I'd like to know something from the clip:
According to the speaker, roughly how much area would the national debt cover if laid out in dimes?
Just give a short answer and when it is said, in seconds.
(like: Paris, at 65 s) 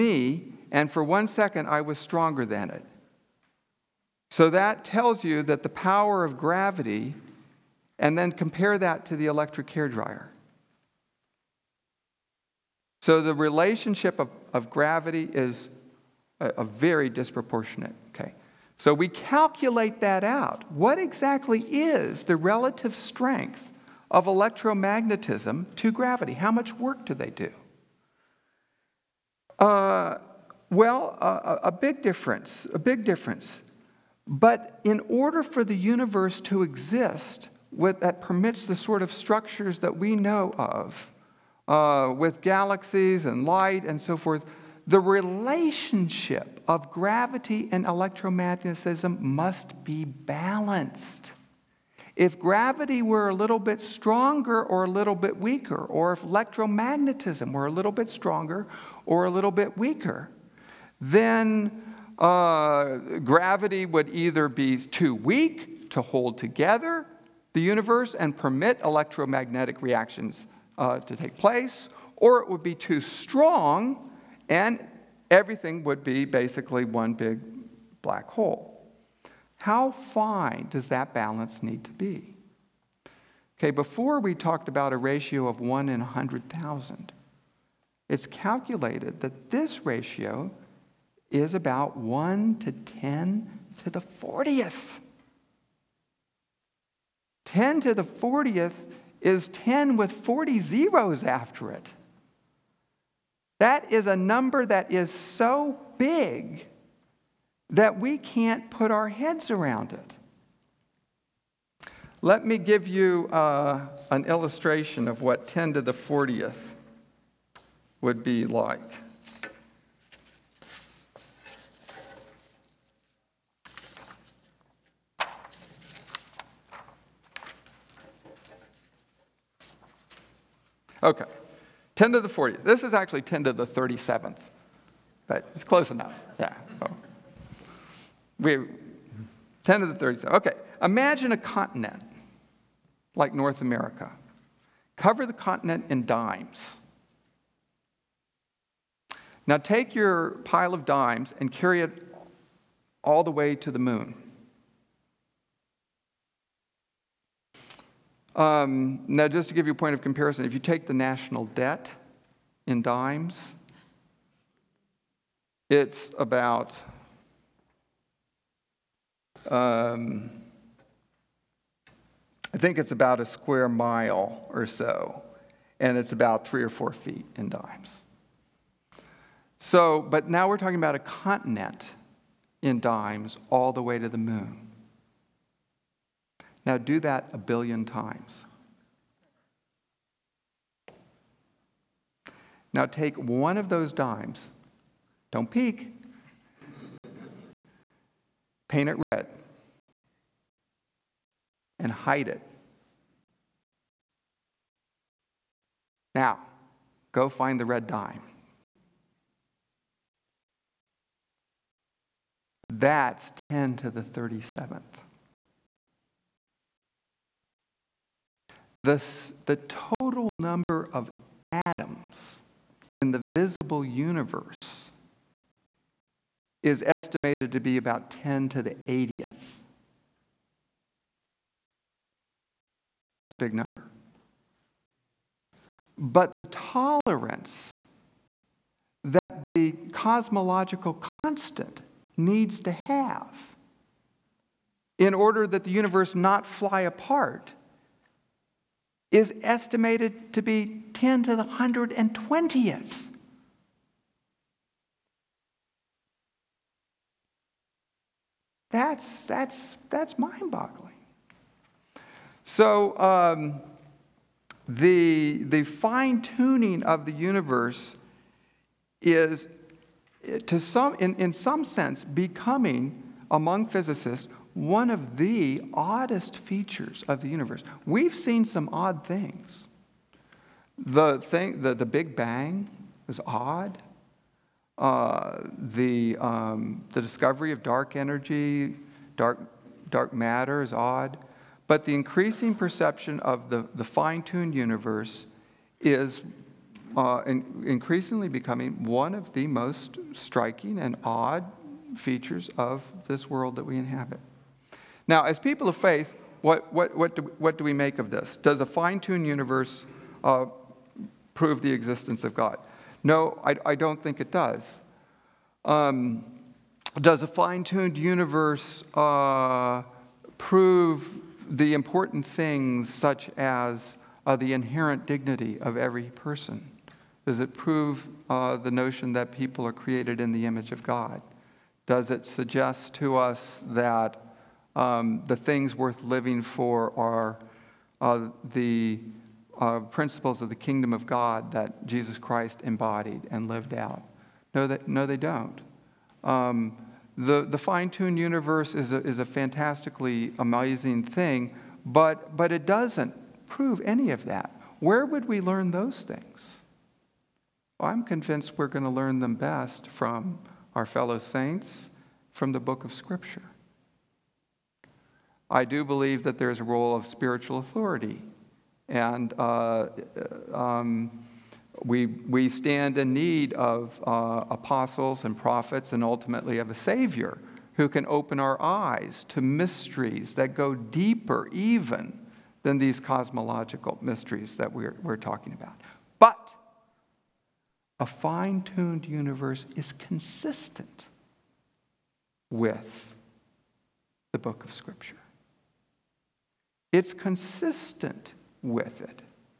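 A square mile, at 173 s.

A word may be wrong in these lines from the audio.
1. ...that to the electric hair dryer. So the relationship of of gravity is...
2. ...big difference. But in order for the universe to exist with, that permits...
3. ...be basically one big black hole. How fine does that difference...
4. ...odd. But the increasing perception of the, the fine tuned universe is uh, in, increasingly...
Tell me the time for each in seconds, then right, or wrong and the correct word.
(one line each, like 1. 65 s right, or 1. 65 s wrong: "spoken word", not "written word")
1. 8 s right
2. 32 s right
3. 76 s wrong: "balance", not "difference"
4. 290 s right.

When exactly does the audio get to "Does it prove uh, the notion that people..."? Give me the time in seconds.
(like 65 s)
327 s.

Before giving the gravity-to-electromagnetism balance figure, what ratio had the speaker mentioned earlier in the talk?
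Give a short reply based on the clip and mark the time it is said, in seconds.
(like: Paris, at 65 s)
1 in 100,000, at 85 s.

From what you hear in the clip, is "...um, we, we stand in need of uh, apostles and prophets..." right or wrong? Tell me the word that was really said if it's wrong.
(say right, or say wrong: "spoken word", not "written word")
right.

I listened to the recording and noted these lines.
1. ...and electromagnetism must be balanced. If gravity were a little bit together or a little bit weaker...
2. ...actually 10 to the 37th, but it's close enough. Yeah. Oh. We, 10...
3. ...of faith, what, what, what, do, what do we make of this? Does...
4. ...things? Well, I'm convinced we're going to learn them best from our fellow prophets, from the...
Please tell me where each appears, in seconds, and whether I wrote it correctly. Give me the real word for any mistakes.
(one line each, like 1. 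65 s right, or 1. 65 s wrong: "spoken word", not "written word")
1. 47 s wrong: "stronger", not "together"
2. 132 s right
3. 305 s right
4. 356 s wrong: "saints", not "prophets".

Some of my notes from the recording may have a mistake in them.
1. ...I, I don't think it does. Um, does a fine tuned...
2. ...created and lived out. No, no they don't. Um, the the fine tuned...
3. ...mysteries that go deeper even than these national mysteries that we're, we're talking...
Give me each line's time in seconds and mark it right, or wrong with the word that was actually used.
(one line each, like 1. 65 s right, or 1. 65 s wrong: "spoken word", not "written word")
1. 313 s right
2. 342 s wrong: "embodied", not "created"
3. 379 s wrong: "cosmological", not "national".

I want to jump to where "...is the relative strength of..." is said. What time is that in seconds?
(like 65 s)
21 s.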